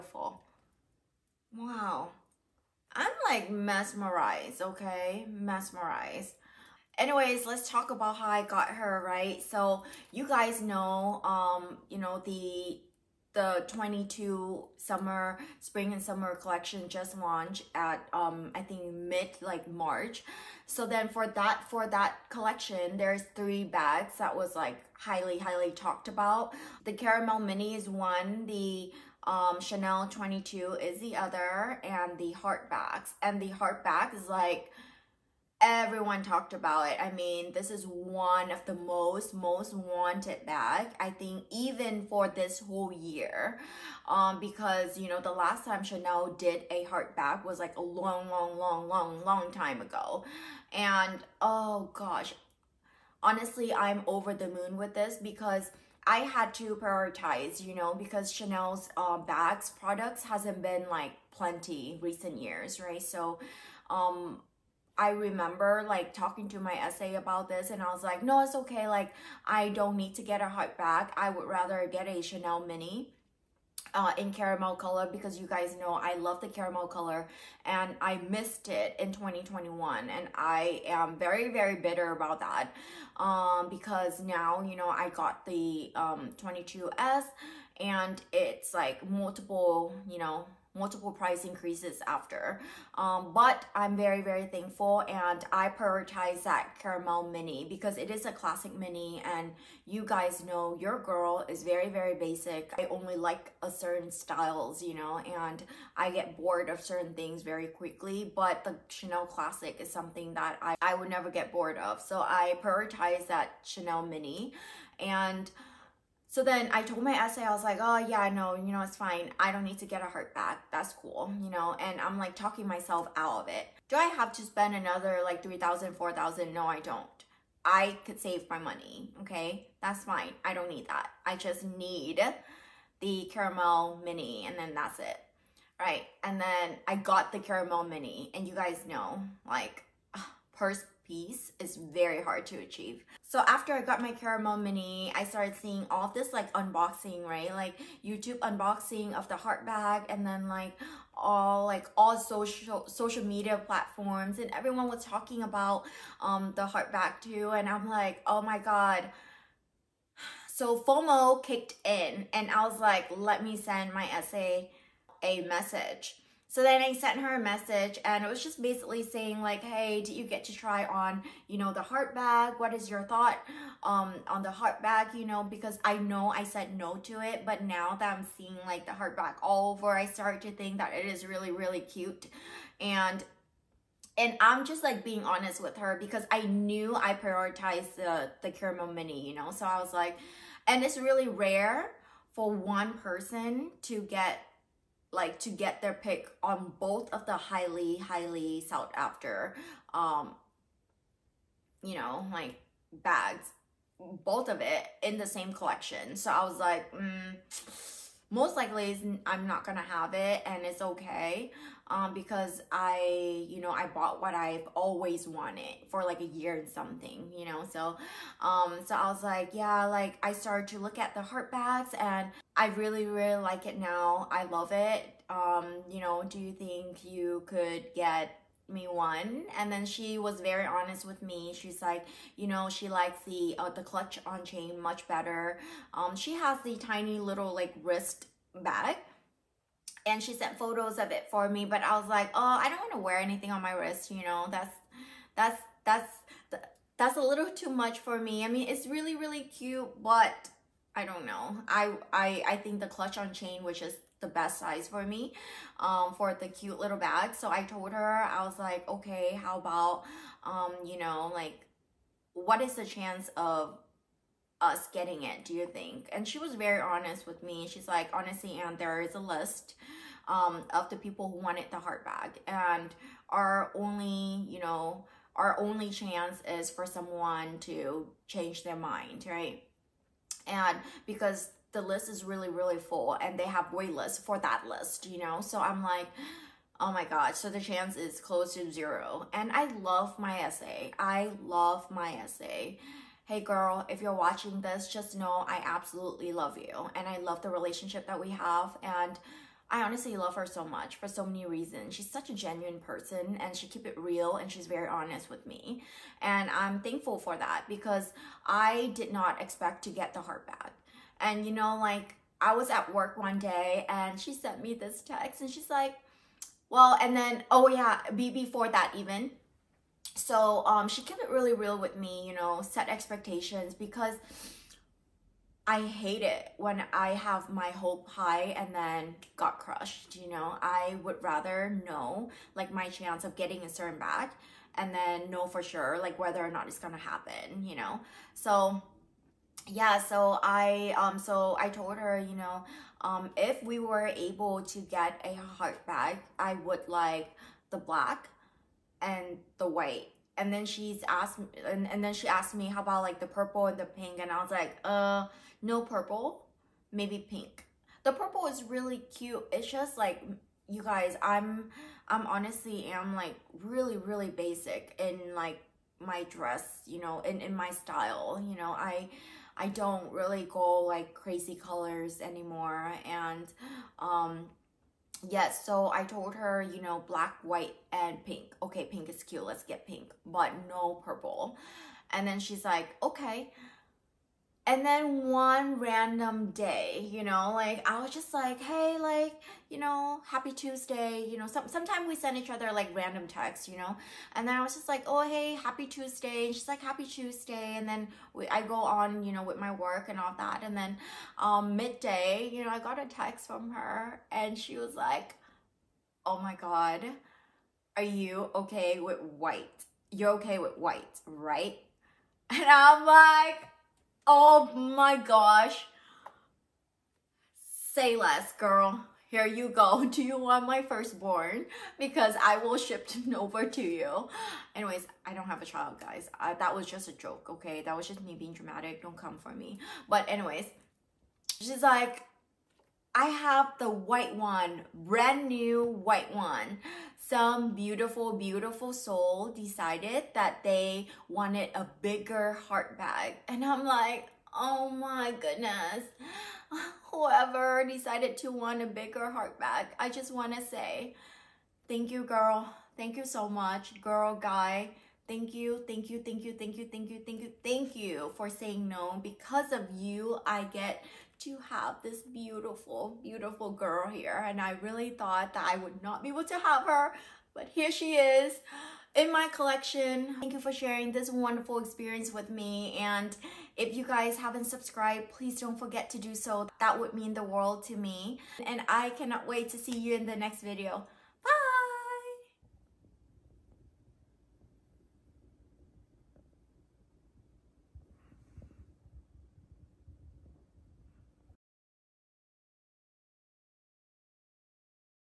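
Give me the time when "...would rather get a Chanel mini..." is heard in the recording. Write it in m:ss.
1:11.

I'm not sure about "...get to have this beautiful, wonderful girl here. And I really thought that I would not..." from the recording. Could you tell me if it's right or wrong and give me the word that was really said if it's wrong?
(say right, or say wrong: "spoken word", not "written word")
wrong: "beautiful", not "wonderful".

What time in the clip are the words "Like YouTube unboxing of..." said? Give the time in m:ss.
2:27.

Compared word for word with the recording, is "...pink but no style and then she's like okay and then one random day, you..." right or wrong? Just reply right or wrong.
wrong.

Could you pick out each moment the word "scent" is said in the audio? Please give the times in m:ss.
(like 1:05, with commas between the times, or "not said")
not said.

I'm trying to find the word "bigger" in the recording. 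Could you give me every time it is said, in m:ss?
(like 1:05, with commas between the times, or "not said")
7:22, 7:28.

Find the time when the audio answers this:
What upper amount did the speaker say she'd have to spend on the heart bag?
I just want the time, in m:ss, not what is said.
2:05.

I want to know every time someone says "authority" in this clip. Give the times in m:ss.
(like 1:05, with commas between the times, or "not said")
not said.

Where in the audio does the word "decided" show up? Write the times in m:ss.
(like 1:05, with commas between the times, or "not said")
7:19, 7:27.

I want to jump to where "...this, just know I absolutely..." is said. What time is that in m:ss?
4:54.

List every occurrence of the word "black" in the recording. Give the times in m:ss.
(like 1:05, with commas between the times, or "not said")
5:47, 6:17.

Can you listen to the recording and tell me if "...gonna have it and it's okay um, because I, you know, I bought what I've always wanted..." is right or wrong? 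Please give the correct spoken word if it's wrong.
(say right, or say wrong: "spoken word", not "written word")
right.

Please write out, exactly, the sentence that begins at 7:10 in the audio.
But anyways, she's like, I have the white one, brand new white one.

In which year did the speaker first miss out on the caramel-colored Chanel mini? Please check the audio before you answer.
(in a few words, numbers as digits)
2021.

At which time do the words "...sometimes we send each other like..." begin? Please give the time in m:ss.
6:31.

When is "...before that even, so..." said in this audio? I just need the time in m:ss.
5:18.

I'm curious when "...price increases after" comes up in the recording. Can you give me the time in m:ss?
1:31.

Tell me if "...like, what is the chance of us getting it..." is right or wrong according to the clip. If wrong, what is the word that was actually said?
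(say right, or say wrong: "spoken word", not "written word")
right.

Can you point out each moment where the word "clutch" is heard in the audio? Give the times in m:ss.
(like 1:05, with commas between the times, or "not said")
3:53, 4:12.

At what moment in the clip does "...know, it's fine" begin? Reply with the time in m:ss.
1:58.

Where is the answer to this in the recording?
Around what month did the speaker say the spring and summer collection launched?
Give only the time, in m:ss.
0:19.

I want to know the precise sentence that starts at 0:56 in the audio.
I had to prioritize, you know, because Chanel's uh, bags products hasn't been like plenty recent years, right?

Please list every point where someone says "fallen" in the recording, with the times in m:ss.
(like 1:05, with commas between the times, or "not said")
not said.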